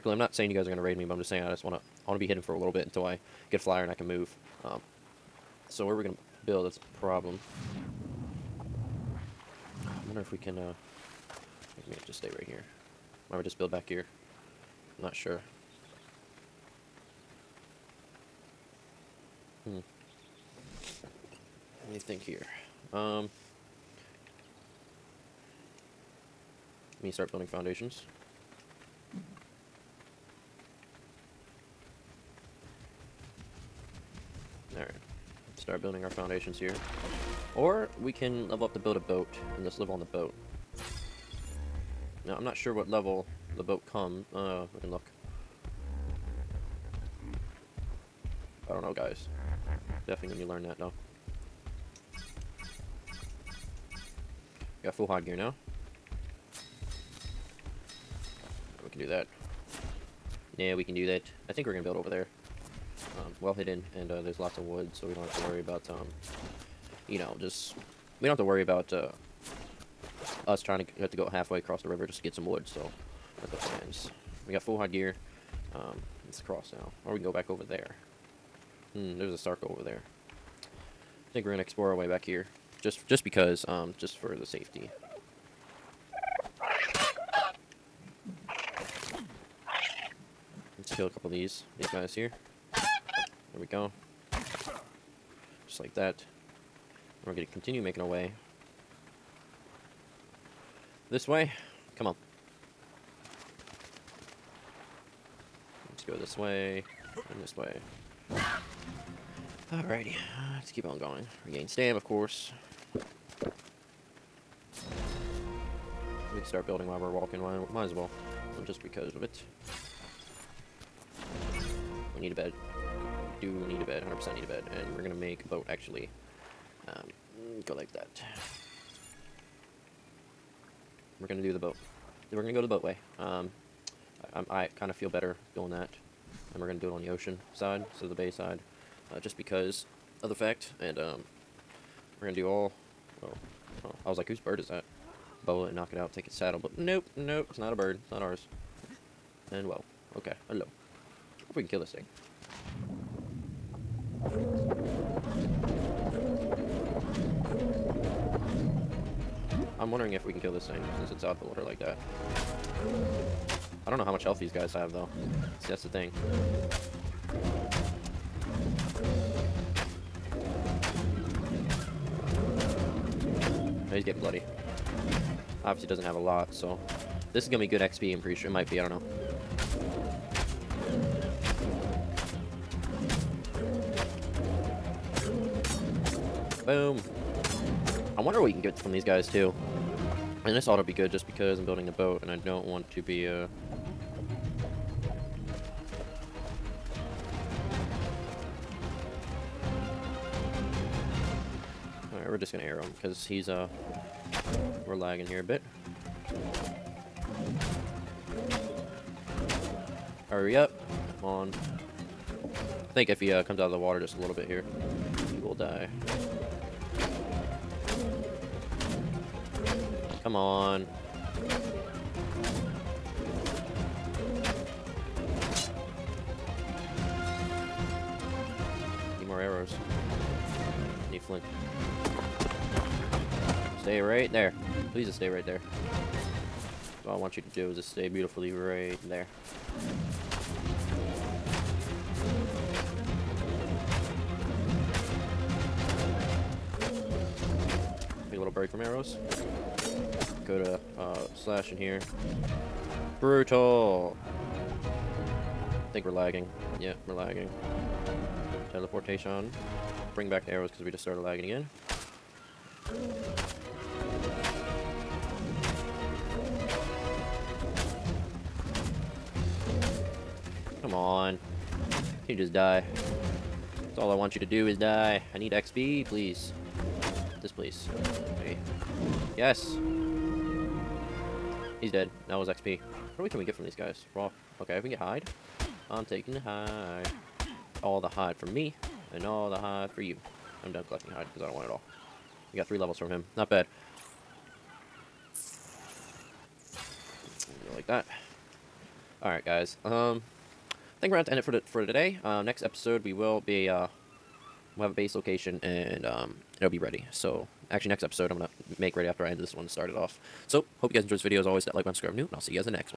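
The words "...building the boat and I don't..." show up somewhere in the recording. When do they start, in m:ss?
3:11.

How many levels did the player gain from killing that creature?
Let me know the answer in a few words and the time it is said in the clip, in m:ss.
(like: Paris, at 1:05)
3, at 4:52.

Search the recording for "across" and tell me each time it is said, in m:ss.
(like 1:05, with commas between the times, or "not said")
1:11, 1:16.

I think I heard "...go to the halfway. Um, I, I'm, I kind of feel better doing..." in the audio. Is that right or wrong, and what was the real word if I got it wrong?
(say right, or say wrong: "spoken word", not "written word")
wrong: "boatway", not "halfway".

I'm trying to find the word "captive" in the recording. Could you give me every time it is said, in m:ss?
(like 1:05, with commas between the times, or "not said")
not said.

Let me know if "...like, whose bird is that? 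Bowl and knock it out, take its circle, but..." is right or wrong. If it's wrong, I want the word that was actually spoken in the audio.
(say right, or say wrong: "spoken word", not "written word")
wrong: "saddle", not "circle".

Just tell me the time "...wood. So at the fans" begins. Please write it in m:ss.
1:12.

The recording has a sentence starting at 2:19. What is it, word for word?
Uh, just because of the fact.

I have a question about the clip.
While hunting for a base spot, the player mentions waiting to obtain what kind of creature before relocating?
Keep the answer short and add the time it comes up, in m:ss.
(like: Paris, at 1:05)
a flyer, at 0:03.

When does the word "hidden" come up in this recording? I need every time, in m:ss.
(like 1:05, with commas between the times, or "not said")
0:02, 1:03.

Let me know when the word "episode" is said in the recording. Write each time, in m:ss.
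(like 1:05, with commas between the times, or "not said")
5:02, 5:08.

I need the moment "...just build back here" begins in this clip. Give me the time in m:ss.
0:13.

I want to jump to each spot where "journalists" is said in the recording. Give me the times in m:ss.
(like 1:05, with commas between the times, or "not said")
not said.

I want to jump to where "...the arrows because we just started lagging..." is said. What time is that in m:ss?
4:20.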